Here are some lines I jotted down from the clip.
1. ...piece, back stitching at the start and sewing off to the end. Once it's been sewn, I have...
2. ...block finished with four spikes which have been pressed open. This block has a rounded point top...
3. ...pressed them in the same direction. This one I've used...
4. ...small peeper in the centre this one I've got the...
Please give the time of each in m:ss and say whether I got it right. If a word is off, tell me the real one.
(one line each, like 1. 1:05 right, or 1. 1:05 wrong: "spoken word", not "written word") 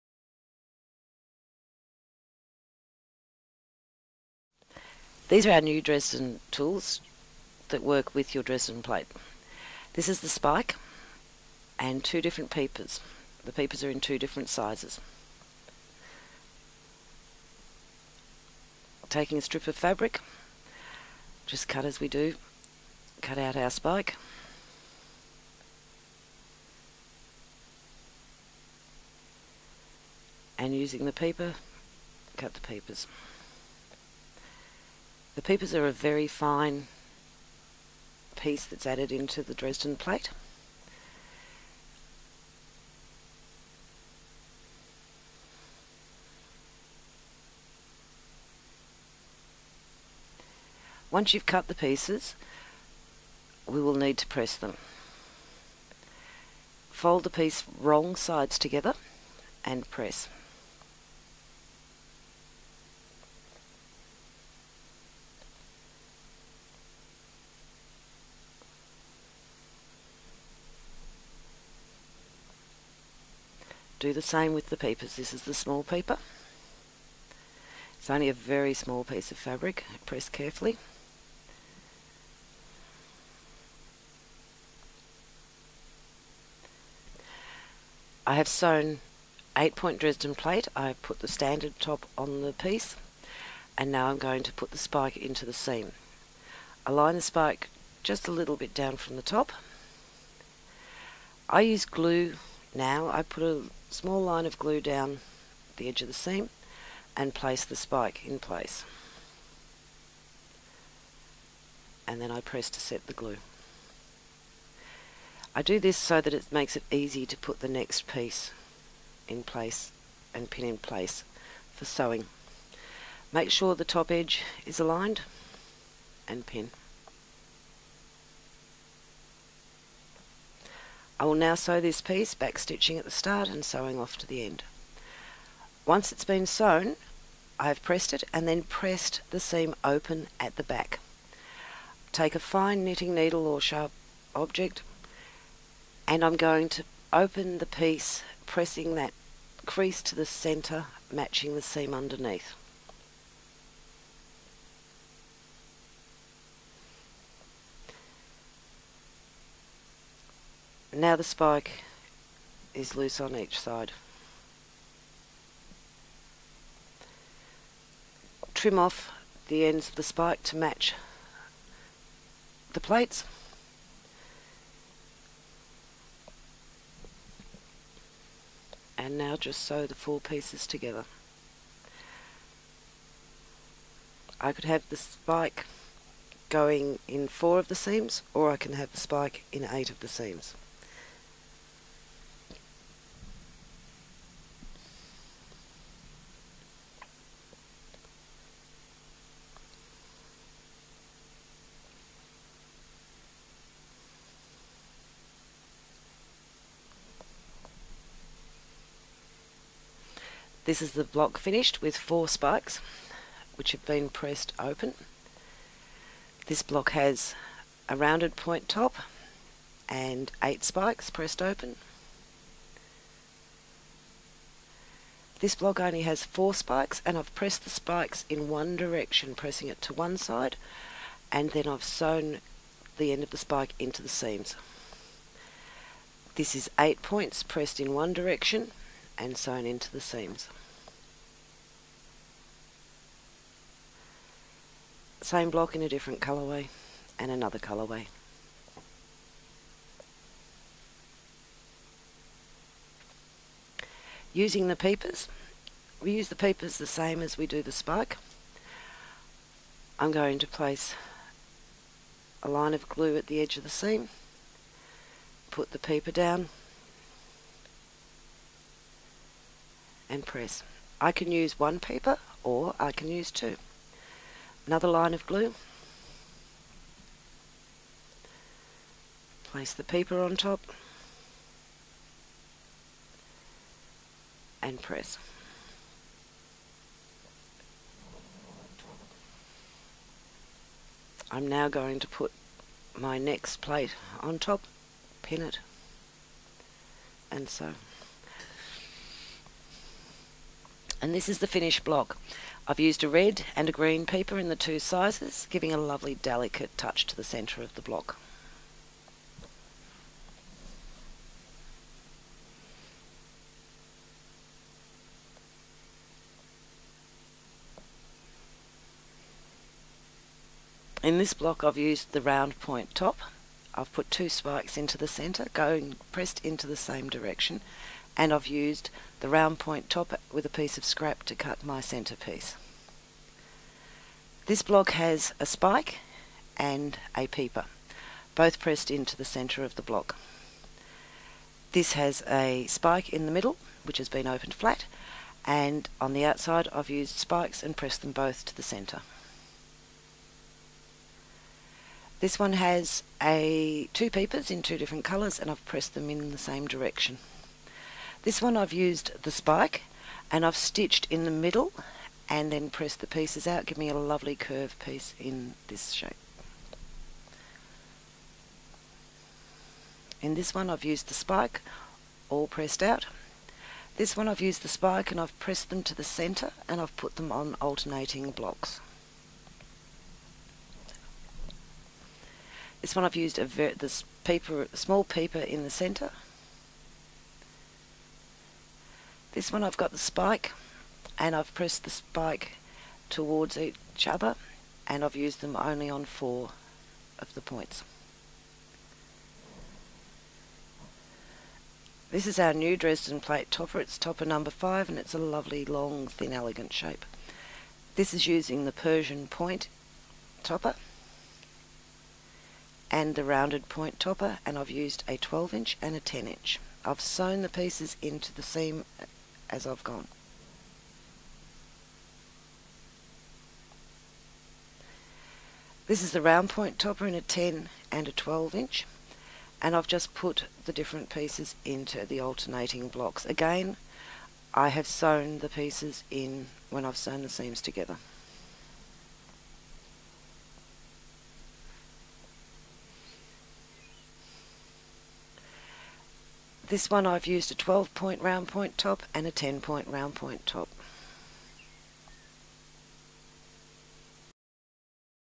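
1. 2:12 right
2. 3:31 right
3. 5:55 right
4. 6:24 right.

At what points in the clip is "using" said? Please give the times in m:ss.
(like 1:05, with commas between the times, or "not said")
0:30, 4:14, 6:48.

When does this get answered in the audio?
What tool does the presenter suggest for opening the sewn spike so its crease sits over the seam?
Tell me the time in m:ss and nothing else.
2:22.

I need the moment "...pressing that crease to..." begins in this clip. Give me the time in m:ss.
2:28.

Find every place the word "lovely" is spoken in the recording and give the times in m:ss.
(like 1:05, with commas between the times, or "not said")
5:05, 6:03, 6:45.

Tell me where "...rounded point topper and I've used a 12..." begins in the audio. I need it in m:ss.
6:53.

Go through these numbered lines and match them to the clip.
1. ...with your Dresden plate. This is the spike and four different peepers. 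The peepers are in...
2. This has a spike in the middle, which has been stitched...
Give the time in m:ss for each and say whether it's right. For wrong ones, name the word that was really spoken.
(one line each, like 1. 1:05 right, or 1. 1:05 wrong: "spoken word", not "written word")
1. 0:08 wrong: "two", not "four"
2. 5:41 wrong: "opened", not "stitched".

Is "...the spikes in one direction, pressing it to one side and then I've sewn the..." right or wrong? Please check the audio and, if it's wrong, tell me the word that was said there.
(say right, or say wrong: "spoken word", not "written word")
right.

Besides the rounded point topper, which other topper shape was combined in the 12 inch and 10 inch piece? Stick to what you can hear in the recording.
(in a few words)
Persian point.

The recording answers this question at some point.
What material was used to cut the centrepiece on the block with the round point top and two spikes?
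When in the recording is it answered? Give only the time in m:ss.
5:30.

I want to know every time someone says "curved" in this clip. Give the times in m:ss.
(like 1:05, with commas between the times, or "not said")
6:04.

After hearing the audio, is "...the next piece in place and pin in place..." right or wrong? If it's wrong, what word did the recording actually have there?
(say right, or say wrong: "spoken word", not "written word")
right.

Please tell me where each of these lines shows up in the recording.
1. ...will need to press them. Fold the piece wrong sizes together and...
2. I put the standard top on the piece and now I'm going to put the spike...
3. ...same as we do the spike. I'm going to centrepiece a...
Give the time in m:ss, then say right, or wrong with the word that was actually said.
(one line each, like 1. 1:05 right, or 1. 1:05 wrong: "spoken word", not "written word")
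1. 0:53 wrong: "sides", not "sizes"
2. 1:30 right
3. 4:16 wrong: "place", not "centrepiece".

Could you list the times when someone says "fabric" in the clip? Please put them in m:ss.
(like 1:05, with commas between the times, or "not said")
0:19, 1:19.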